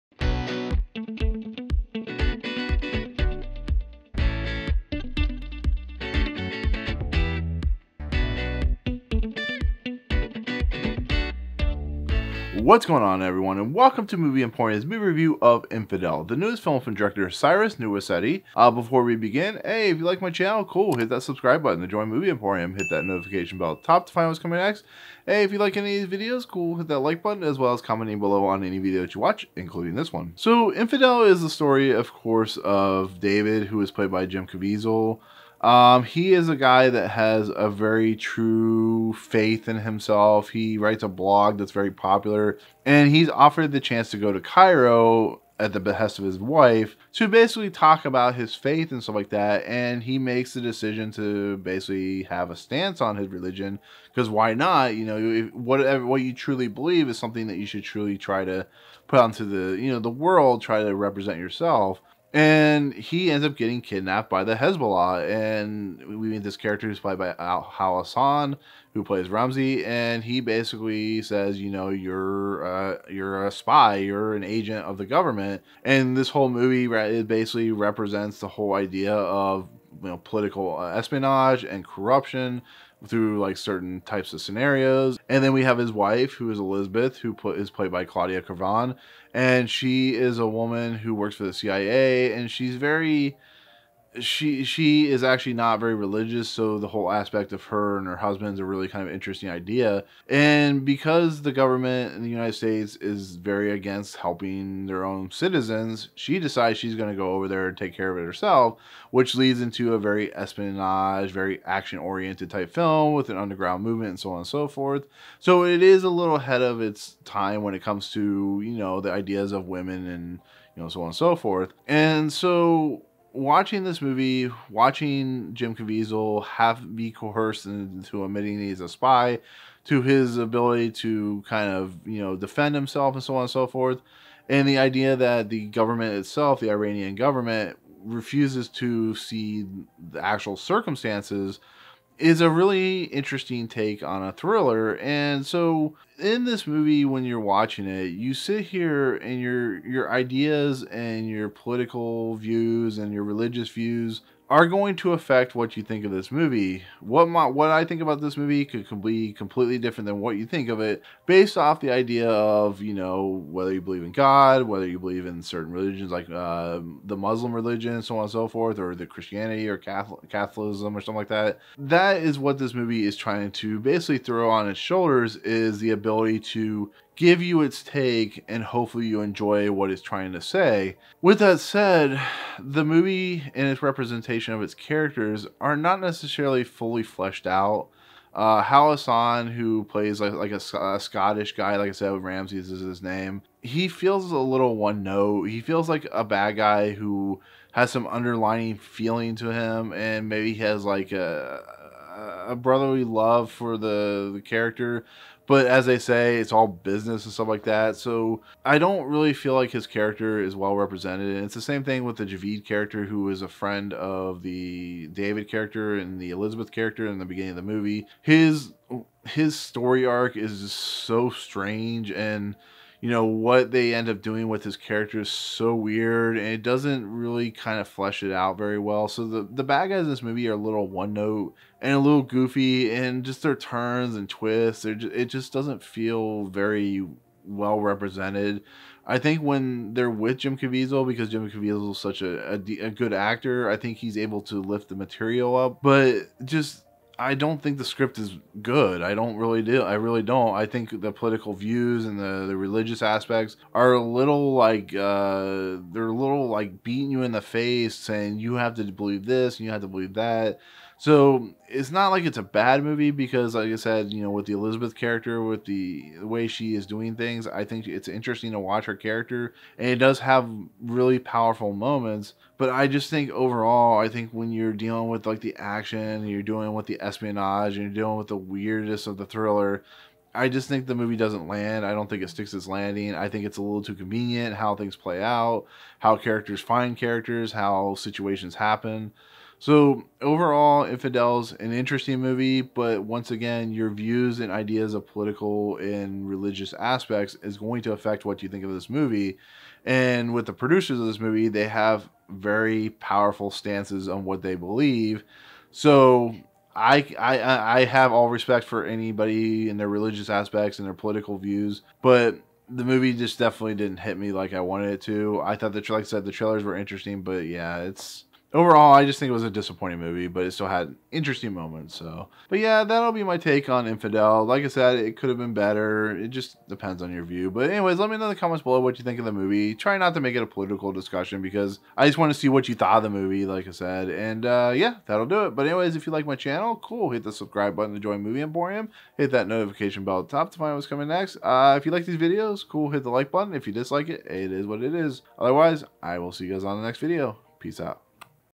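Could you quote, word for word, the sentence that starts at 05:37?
Hit the subscribe button to join Movie Emporium.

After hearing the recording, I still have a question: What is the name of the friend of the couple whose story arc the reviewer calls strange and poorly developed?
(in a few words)
Javid.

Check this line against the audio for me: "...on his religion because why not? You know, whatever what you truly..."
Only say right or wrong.
right.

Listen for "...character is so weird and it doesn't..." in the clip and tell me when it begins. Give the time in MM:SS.
03:44.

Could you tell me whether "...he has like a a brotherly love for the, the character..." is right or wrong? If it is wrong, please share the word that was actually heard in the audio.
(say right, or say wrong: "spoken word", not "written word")
right.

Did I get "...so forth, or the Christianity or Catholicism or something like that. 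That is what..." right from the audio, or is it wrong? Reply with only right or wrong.
right.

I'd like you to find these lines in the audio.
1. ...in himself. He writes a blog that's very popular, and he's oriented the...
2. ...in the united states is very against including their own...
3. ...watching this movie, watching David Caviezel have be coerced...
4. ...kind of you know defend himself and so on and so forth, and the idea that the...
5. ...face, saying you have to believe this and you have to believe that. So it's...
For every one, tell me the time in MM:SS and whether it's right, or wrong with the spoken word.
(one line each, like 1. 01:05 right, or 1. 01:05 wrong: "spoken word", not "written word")
1. 00:39 wrong: "offered", not "oriented"
2. 01:42 wrong: "helping", not "including"
3. 02:03 wrong: "Jim", not "David"
4. 02:11 right
5. 04:17 right.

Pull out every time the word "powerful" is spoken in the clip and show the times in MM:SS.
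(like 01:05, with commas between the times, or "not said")
04:31, 05:02.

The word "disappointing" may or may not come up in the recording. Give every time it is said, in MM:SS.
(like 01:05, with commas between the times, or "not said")
05:19.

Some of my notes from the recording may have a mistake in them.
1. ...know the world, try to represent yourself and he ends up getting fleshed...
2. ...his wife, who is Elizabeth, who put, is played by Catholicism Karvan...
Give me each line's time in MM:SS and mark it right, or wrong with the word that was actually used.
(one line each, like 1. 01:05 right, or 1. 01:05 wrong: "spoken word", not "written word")
1. 00:59 wrong: "kidnapped", not "fleshed"
2. 01:25 wrong: "Claudia", not "Catholicism".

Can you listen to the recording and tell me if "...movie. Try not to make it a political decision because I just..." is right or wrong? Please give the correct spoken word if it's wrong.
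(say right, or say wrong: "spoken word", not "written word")
wrong: "discussion", not "decision".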